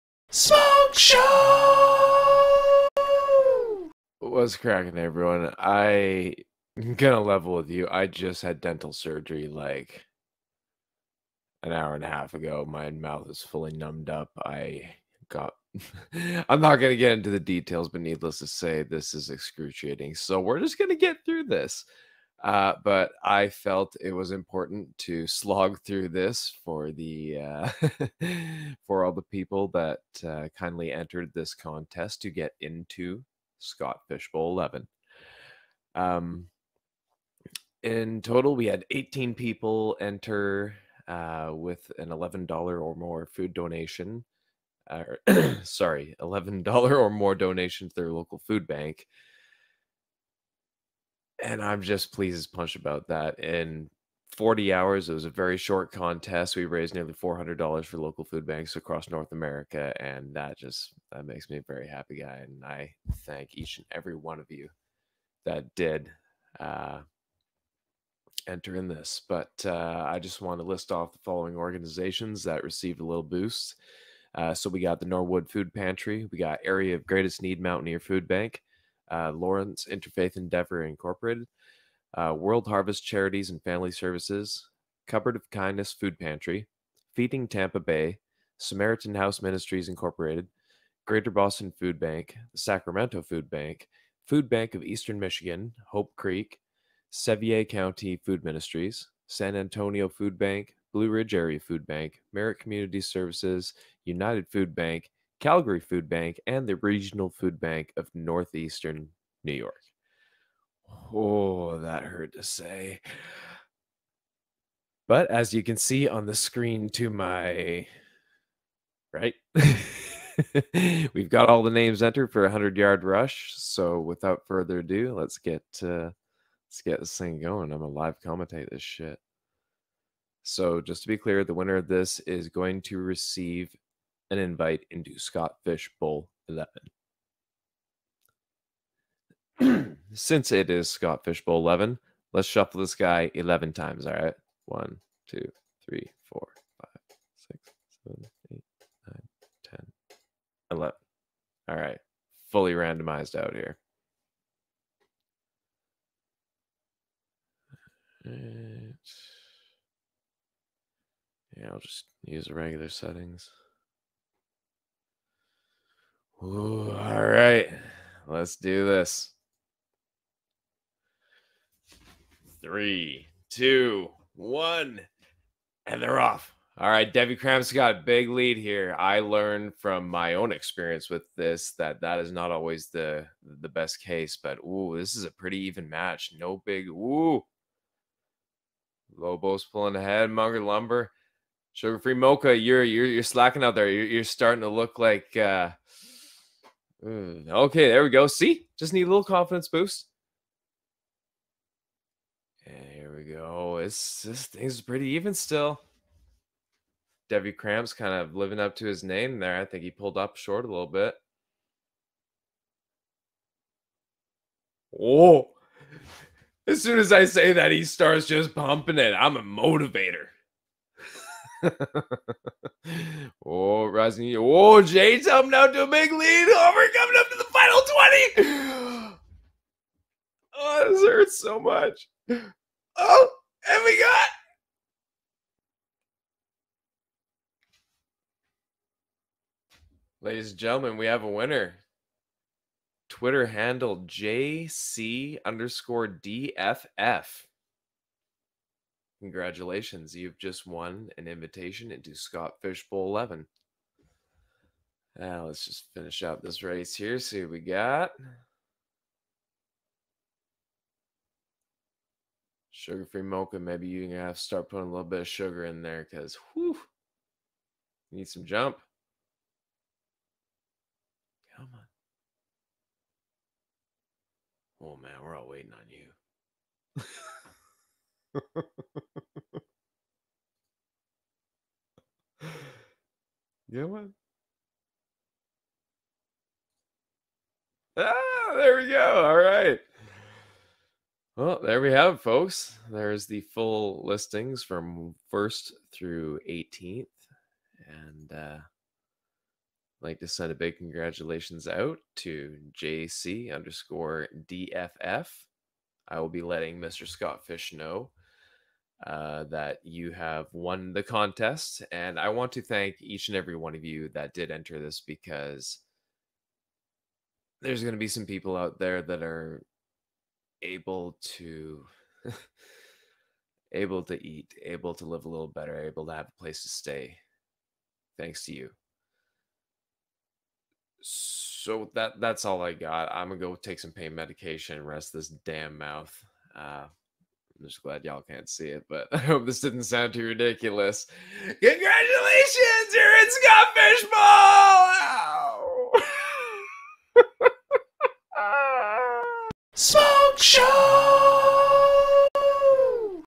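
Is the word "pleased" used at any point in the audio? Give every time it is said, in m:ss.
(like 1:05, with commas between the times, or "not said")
0:52.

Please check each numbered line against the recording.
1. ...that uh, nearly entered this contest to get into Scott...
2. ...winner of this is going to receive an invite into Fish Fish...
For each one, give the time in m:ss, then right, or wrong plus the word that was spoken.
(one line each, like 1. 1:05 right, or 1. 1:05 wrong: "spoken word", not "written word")
1. 0:29 wrong: "kindly", not "nearly"
2. 2:11 wrong: "Scott", not "Fish".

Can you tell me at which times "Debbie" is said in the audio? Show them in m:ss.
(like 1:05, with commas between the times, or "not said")
2:57, 3:27.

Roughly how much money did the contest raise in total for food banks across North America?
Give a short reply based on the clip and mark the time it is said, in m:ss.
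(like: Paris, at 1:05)
nearly $400, at 0:56.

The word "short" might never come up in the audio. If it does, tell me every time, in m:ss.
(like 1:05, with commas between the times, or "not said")
0:55, 3:30.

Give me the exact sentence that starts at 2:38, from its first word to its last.
Yeah, I'll just use the regular settings.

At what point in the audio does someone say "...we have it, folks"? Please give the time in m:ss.
4:51.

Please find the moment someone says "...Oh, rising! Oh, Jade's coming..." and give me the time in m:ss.
3:43.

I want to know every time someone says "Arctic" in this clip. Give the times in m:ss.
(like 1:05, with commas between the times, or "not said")
not said.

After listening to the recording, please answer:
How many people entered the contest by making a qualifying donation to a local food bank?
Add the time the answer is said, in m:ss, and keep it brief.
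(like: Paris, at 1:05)
18, at 0:38.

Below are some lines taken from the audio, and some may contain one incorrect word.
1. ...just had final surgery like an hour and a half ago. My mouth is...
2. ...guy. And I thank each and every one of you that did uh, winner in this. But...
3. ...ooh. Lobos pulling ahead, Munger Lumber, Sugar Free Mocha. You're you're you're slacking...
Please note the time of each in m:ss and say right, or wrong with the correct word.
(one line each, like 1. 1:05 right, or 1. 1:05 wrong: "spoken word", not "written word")
1. 0:08 wrong: "dental", not "final"
2. 1:02 wrong: "enter", not "winner"
3. 3:06 right.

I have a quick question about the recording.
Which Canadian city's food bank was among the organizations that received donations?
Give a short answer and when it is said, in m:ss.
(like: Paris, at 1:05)
Calgary, at 1:45.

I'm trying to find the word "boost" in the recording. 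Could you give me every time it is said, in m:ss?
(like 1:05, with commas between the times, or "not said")
1:13, 3:19.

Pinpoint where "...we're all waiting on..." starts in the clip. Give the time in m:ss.
4:35.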